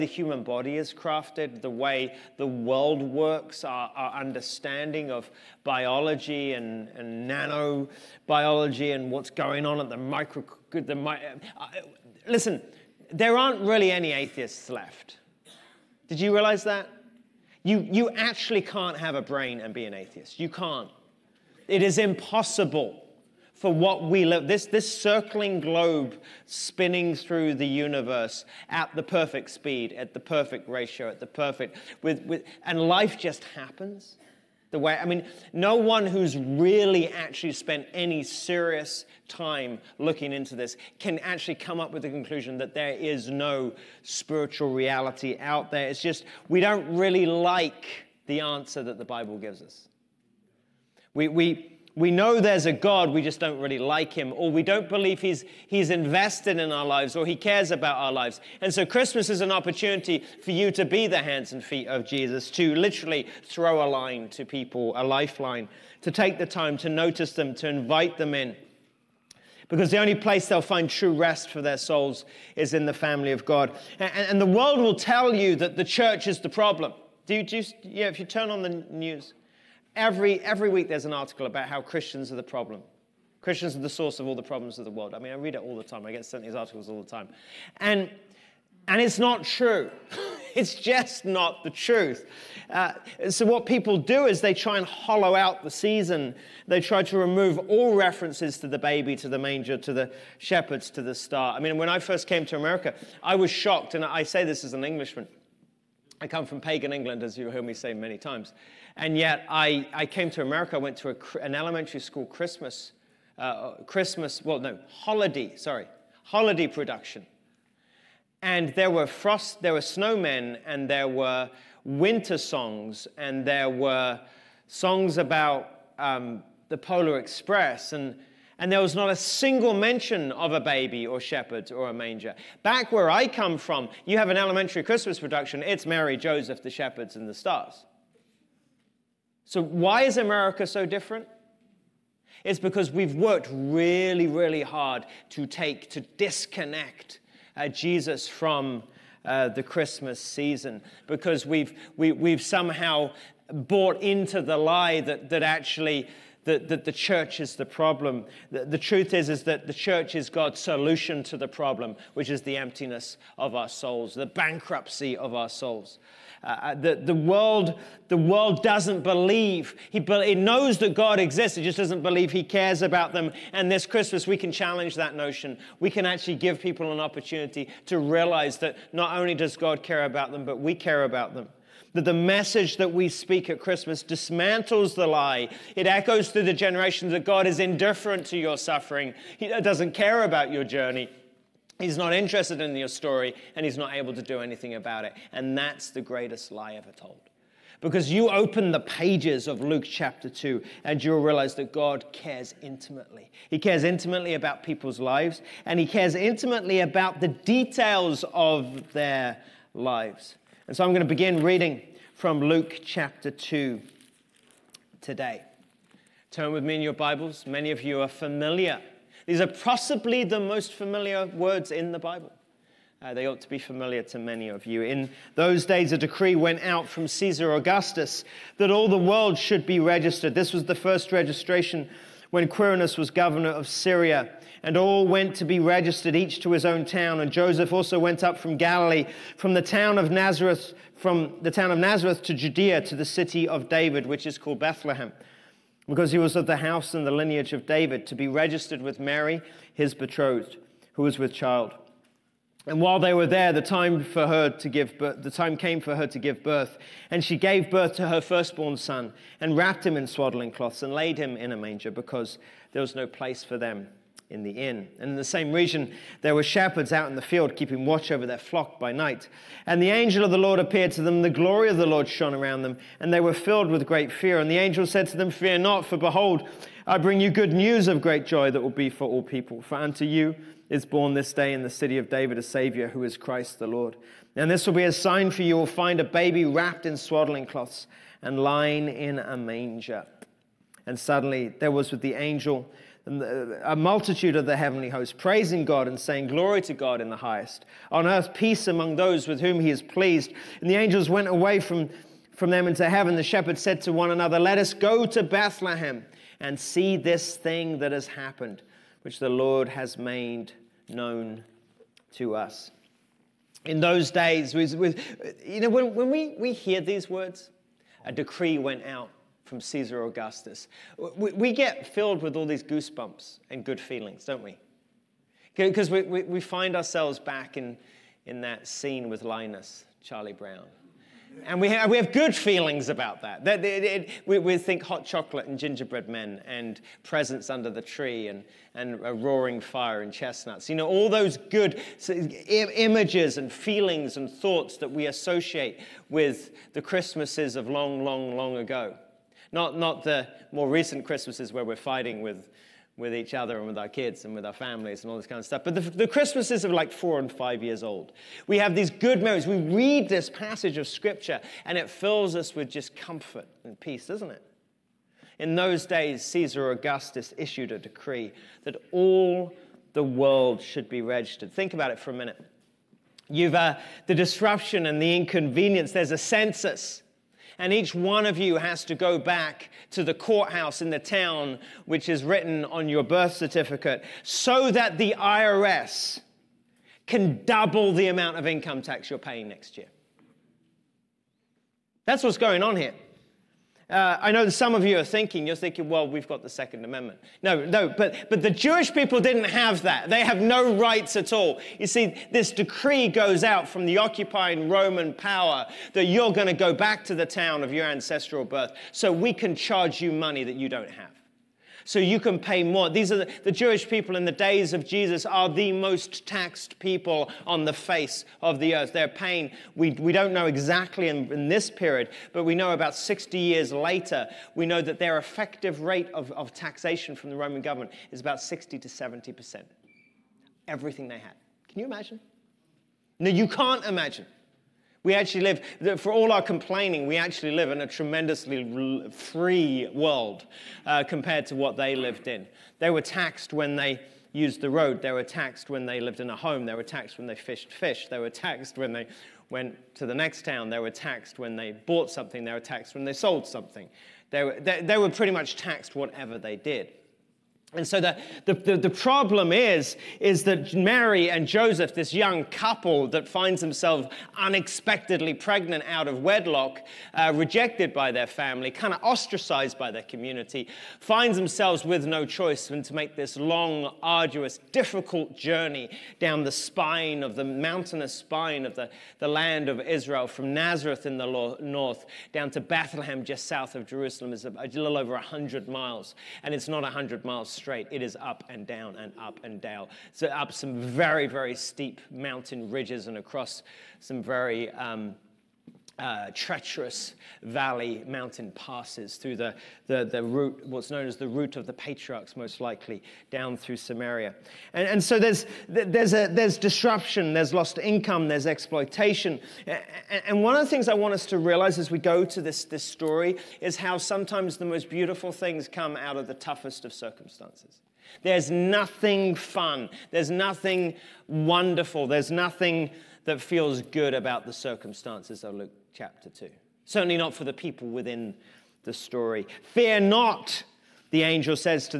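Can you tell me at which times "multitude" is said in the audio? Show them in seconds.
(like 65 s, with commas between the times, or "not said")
293 s.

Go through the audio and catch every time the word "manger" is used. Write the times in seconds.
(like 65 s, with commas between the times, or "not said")
99 s, 131 s, 261 s, 289 s.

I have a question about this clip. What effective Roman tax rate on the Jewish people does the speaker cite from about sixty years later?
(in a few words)
60 to 70%.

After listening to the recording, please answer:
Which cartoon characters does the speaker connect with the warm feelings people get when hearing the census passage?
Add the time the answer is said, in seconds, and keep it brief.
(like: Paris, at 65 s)
Linus, Charlie Brown, at 329 s.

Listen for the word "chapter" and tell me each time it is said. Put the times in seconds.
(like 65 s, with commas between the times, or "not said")
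199 s, 212 s, 525 s.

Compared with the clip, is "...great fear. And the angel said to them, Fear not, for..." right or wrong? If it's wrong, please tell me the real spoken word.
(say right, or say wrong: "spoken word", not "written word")
right.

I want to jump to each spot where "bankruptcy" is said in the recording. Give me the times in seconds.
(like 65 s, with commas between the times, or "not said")
164 s.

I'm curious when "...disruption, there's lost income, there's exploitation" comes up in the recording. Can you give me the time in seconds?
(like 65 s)
506 s.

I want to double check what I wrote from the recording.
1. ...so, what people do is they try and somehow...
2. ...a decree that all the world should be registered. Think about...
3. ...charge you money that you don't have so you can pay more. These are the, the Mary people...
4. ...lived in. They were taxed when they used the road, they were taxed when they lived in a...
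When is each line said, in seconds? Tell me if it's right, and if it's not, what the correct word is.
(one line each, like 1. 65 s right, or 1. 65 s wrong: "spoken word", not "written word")
1. 93 s wrong: "hollow", not "somehow"
2. 367 s right
3. 409 s wrong: "Jewish", not "Mary"
4. 441 s right.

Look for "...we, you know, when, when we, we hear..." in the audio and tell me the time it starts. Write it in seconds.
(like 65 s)
314 s.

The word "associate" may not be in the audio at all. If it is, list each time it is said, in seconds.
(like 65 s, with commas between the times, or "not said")
345 s.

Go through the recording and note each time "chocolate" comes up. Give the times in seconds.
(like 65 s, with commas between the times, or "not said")
335 s.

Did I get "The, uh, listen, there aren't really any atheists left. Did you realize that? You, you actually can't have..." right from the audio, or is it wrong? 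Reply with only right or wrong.
right.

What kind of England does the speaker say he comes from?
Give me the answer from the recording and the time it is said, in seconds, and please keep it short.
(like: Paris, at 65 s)
pagan England, at 106 s.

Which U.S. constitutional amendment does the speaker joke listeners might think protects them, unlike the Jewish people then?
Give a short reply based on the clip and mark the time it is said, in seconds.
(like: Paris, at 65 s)
Second Amendment, at 396 s.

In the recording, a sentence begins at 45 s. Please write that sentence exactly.
It's just, we don't really like the answer that the Bible gives us.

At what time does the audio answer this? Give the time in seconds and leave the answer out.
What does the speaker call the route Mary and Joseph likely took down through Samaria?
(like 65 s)
501 s.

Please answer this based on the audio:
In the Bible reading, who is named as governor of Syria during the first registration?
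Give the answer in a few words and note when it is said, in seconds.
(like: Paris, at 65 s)
Quirinus, at 232 s.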